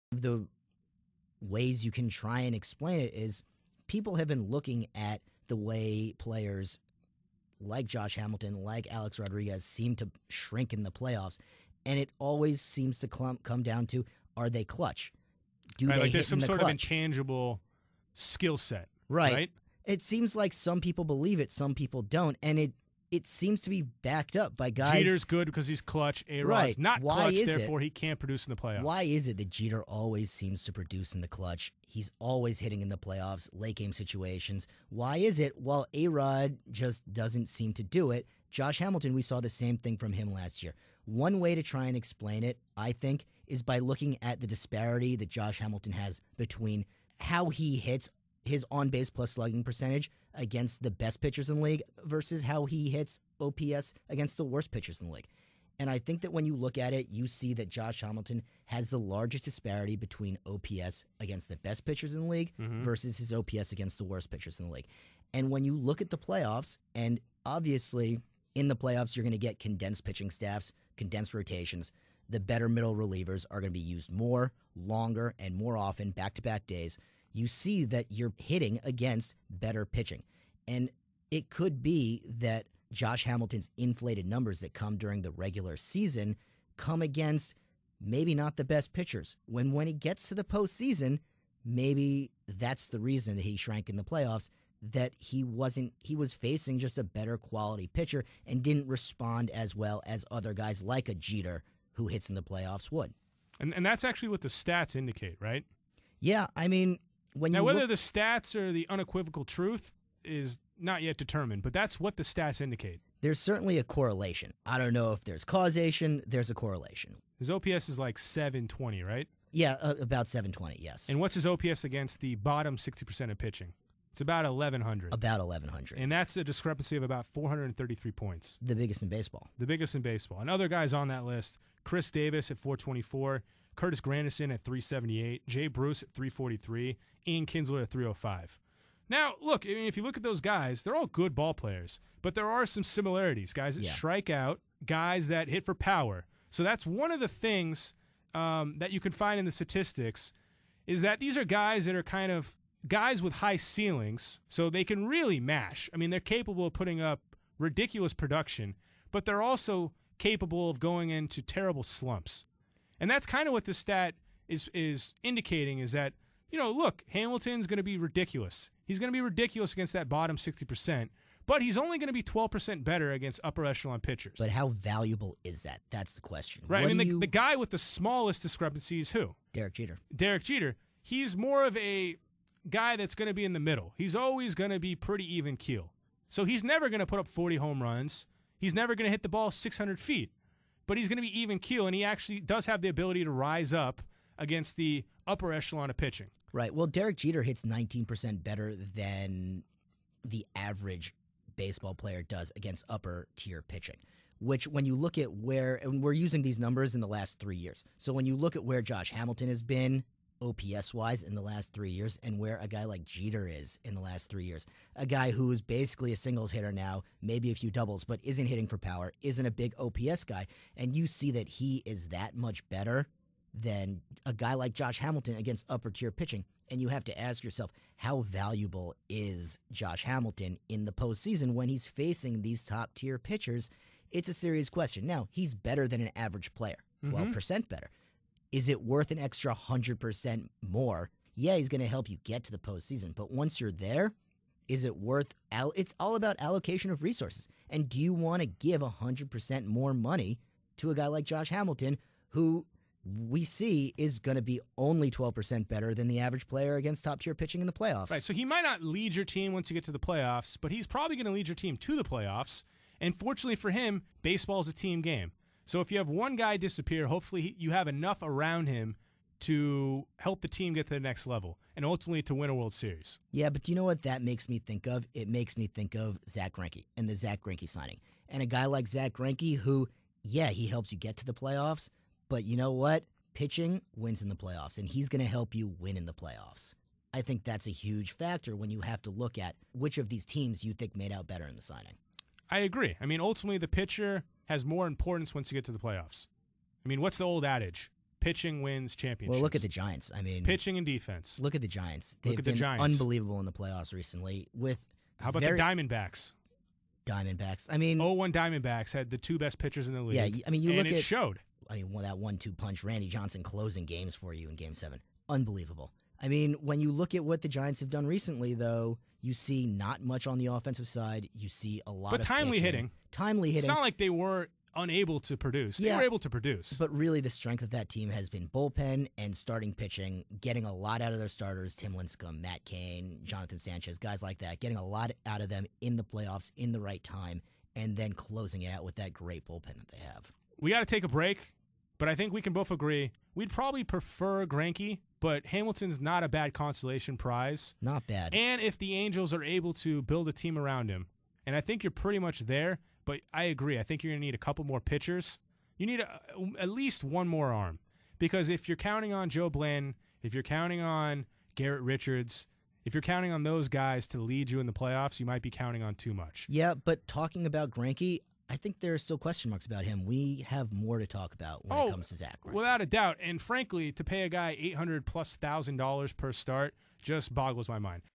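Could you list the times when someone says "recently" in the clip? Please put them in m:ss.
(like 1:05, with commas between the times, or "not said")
5:03, 5:18.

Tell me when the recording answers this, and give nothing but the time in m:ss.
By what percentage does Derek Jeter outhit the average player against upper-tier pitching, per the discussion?
3:17.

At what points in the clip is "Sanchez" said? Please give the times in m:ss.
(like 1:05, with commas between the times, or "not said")
5:33.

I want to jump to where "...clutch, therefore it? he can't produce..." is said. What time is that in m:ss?
0:27.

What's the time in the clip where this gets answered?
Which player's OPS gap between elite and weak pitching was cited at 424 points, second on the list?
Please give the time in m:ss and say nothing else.
2:11.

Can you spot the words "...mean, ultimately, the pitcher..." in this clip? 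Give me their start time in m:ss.
4:53.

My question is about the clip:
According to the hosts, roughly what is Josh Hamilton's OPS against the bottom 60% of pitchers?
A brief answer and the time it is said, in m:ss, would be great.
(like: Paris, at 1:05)
1100, at 2:04.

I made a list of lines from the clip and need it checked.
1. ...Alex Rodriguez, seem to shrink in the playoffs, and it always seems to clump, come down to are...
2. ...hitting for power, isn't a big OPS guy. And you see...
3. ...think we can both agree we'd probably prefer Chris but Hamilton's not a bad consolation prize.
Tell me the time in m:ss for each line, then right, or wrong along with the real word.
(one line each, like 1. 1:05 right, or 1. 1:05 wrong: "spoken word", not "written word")
1. 0:08 right
2. 3:38 right
3. 5:42 wrong: "Greinke", not "Chris".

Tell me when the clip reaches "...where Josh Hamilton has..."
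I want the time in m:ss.
3:28.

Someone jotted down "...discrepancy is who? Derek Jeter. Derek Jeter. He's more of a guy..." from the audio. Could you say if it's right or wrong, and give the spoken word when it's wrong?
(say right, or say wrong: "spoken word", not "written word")
right.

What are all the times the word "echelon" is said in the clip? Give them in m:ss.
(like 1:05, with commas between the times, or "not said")
2:53, 3:15.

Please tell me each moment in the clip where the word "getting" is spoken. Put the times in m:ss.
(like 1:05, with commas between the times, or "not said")
5:30, 5:34.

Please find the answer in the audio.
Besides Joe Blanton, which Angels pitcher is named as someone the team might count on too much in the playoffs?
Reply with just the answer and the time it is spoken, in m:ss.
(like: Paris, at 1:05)
Garrett Richards, at 6:01.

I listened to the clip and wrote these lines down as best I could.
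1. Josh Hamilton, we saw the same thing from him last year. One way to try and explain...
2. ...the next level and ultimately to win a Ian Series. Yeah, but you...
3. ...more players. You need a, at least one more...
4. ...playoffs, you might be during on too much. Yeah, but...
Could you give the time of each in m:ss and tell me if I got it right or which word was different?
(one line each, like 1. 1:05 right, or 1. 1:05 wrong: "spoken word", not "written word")
1. 0:38 right
2. 4:30 wrong: "World", not "Ian"
3. 5:54 wrong: "pitchers", not "players"
4. 6:04 wrong: "counting", not "during".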